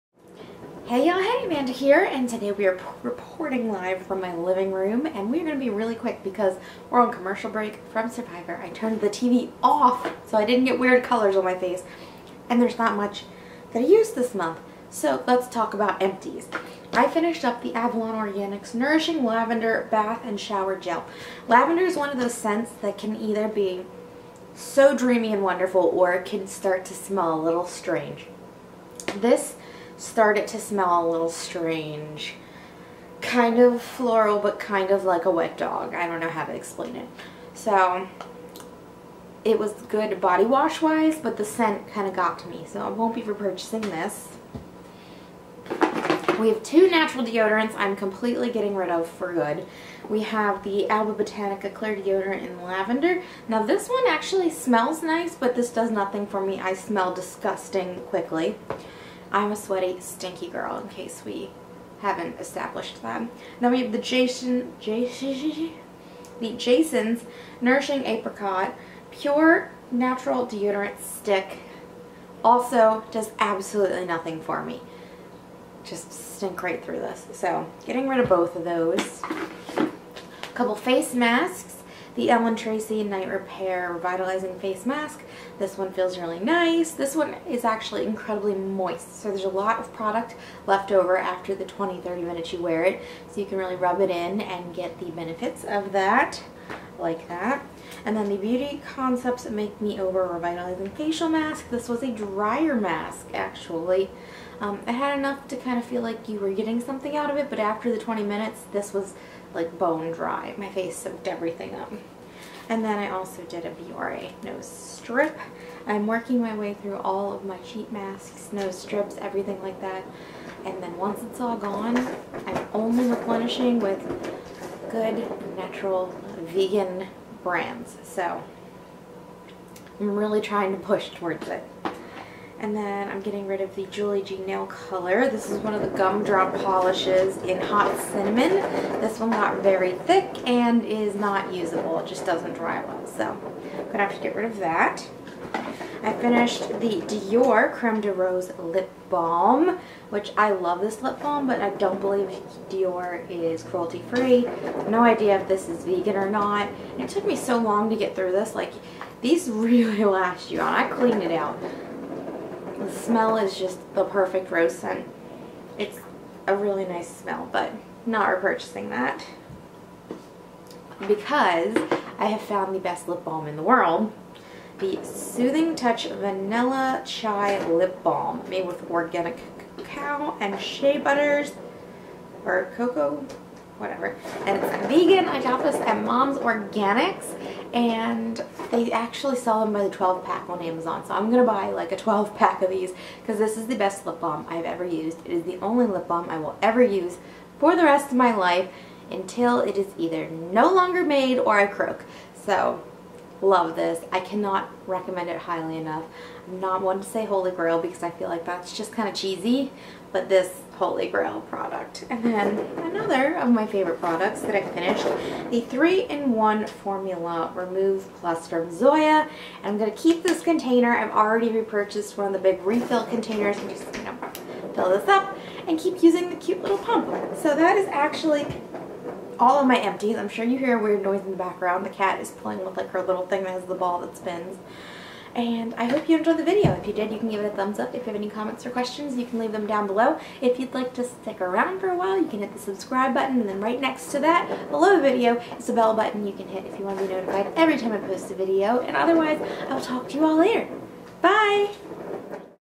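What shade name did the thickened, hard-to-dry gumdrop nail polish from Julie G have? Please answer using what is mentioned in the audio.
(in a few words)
hot cinnamon.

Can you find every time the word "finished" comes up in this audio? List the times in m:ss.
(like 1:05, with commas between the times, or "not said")
0:17, 2:26, 3:34.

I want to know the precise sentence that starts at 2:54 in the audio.
The Soothing Touch Vanilla Chai Lip Balm made with organic cacao and shea butters or cocoa whatever.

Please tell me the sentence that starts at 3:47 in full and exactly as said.
So that is actually all of my empties.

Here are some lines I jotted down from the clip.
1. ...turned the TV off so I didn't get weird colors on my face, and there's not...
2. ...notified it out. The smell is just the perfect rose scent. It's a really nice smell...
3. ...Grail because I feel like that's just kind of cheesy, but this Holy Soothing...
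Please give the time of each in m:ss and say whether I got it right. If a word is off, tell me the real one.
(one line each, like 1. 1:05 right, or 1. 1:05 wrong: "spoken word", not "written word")
1. 0:08 right
2. 2:40 wrong: "cleaned", not "notified"
3. 3:27 wrong: "Grail", not "Soothing".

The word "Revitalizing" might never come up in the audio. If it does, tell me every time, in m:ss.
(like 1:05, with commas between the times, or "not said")
1:23, 1:40.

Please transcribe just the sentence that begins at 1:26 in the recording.
This one is actually incredibly moist.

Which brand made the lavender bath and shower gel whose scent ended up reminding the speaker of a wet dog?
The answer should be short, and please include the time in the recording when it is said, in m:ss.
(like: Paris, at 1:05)
Avalon Organics, at 0:17.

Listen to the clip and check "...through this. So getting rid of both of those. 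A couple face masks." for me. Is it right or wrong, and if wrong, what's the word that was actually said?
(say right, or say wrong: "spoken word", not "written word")
right.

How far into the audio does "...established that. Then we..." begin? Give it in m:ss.
1:02.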